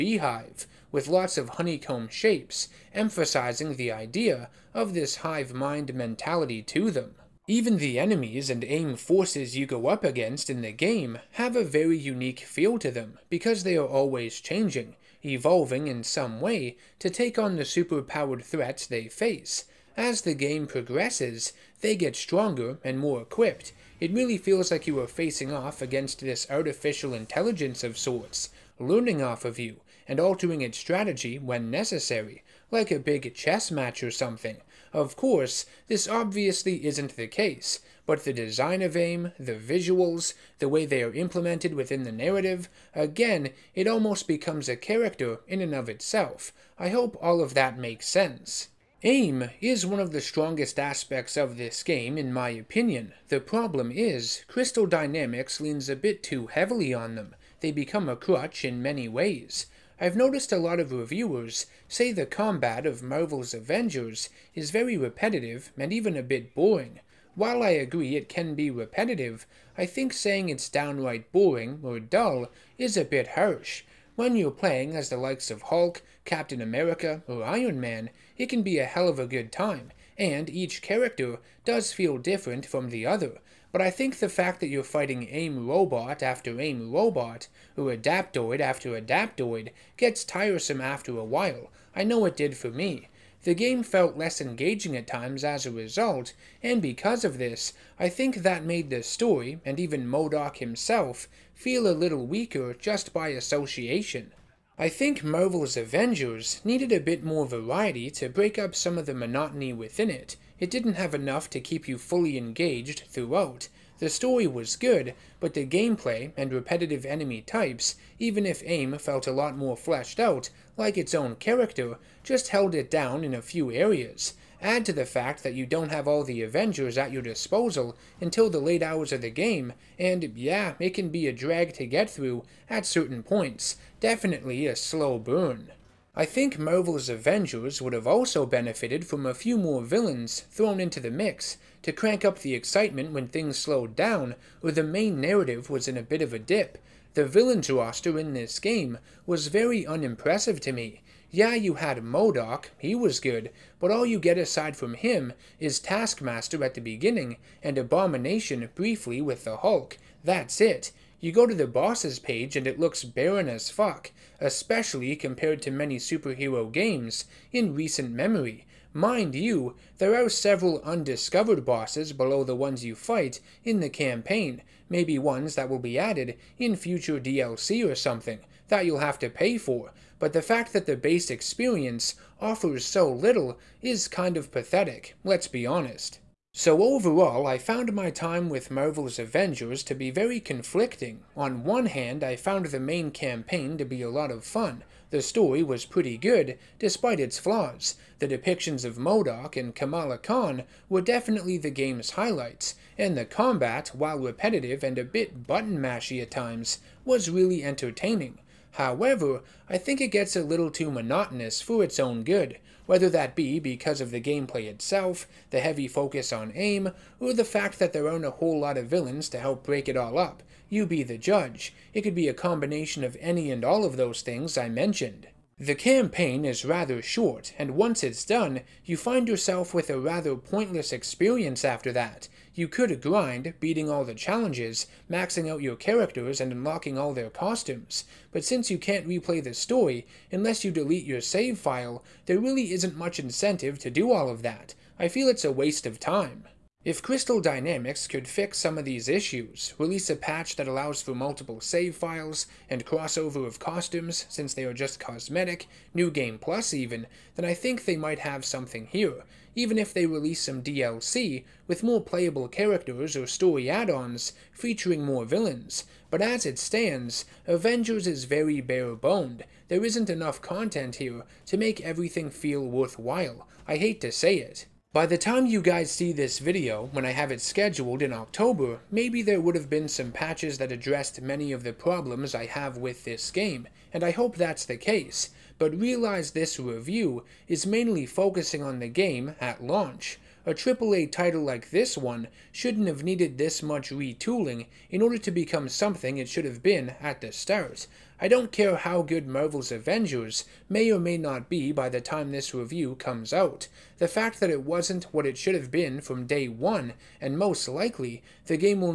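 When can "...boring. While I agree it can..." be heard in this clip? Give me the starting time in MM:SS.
01:06.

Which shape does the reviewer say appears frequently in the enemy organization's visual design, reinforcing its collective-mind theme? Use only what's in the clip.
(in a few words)
Honeycomb.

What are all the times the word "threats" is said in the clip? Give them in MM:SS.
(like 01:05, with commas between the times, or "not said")
00:18.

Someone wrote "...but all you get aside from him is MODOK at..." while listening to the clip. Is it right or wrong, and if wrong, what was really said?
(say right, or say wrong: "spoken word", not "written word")
wrong: "Taskmaster", not "MODOK".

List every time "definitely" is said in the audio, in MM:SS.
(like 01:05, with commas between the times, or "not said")
02:13, 03:21.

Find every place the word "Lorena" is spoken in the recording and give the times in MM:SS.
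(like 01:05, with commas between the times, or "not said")
not said.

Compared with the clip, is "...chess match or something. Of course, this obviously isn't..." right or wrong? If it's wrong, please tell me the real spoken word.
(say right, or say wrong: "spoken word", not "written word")
right.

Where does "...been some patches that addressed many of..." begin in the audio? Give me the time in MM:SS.
04:39.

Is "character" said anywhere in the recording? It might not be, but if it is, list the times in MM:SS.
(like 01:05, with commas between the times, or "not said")
00:44, 01:20, 02:01, 03:55, 04:22.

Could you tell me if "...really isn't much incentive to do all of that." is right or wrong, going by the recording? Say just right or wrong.
right.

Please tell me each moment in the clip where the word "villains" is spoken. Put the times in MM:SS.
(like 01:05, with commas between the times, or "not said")
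02:19, 02:27, 03:38, 04:25.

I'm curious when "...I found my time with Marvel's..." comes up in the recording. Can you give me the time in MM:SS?
03:07.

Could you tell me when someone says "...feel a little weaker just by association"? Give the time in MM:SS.
01:41.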